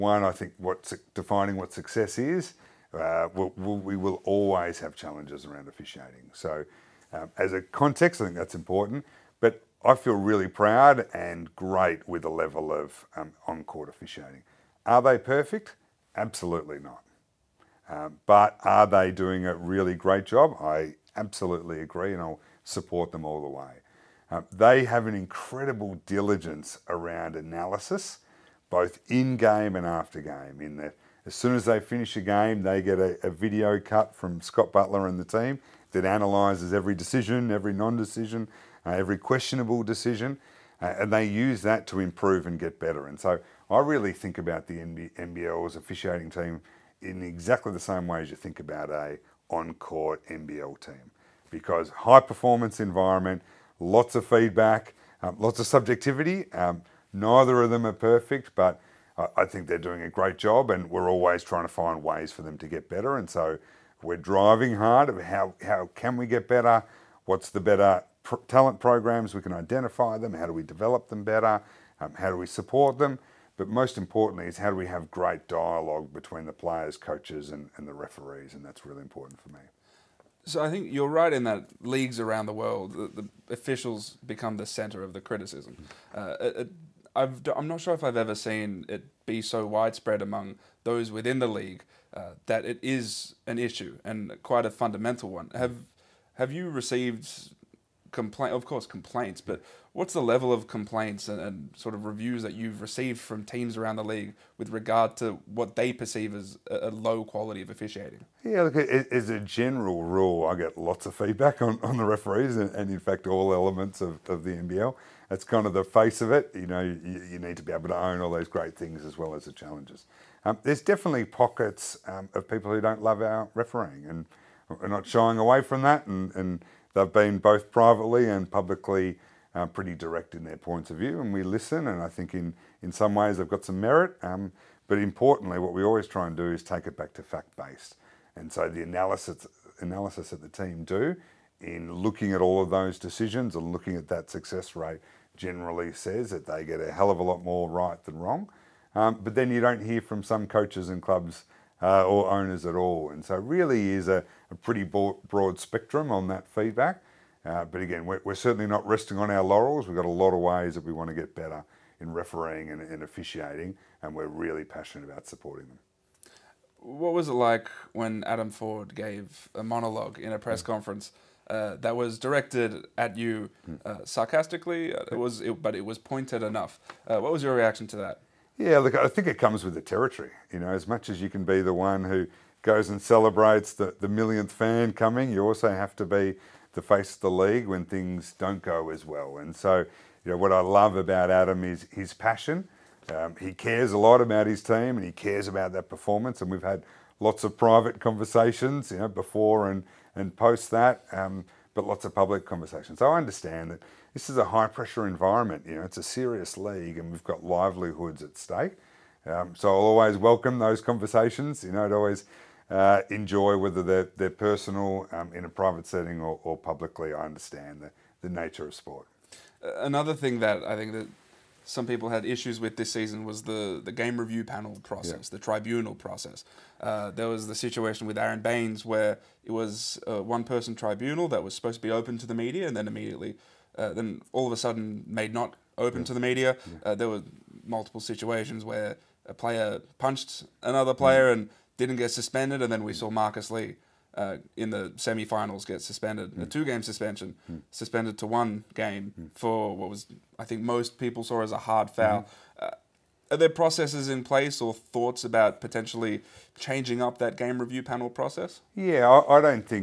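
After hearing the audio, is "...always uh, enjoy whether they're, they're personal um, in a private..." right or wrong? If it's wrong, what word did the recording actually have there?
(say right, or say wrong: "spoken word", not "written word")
right.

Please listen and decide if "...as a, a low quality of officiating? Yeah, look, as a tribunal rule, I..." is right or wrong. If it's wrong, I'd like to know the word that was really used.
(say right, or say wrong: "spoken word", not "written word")
wrong: "general", not "tribunal".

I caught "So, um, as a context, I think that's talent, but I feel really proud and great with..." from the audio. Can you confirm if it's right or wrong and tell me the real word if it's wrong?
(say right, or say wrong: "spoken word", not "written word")
wrong: "important", not "talent".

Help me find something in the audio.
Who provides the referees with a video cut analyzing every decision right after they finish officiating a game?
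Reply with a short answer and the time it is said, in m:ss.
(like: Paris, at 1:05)
Scott Butler, at 0:34.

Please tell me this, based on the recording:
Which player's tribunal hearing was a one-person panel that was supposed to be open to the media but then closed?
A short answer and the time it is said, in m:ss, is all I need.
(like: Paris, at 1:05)
Aron Baynes, at 3:48.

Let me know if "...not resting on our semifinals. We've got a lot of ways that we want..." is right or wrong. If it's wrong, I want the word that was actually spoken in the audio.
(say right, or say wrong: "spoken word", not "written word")
wrong: "laurels", not "semifinals".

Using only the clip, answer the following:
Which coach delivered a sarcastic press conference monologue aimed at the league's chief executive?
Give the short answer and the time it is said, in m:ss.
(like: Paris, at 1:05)
Adam Forde, at 2:48.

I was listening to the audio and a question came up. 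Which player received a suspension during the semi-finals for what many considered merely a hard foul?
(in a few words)
Marcus Lee.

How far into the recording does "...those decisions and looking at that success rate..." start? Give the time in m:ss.
2:22.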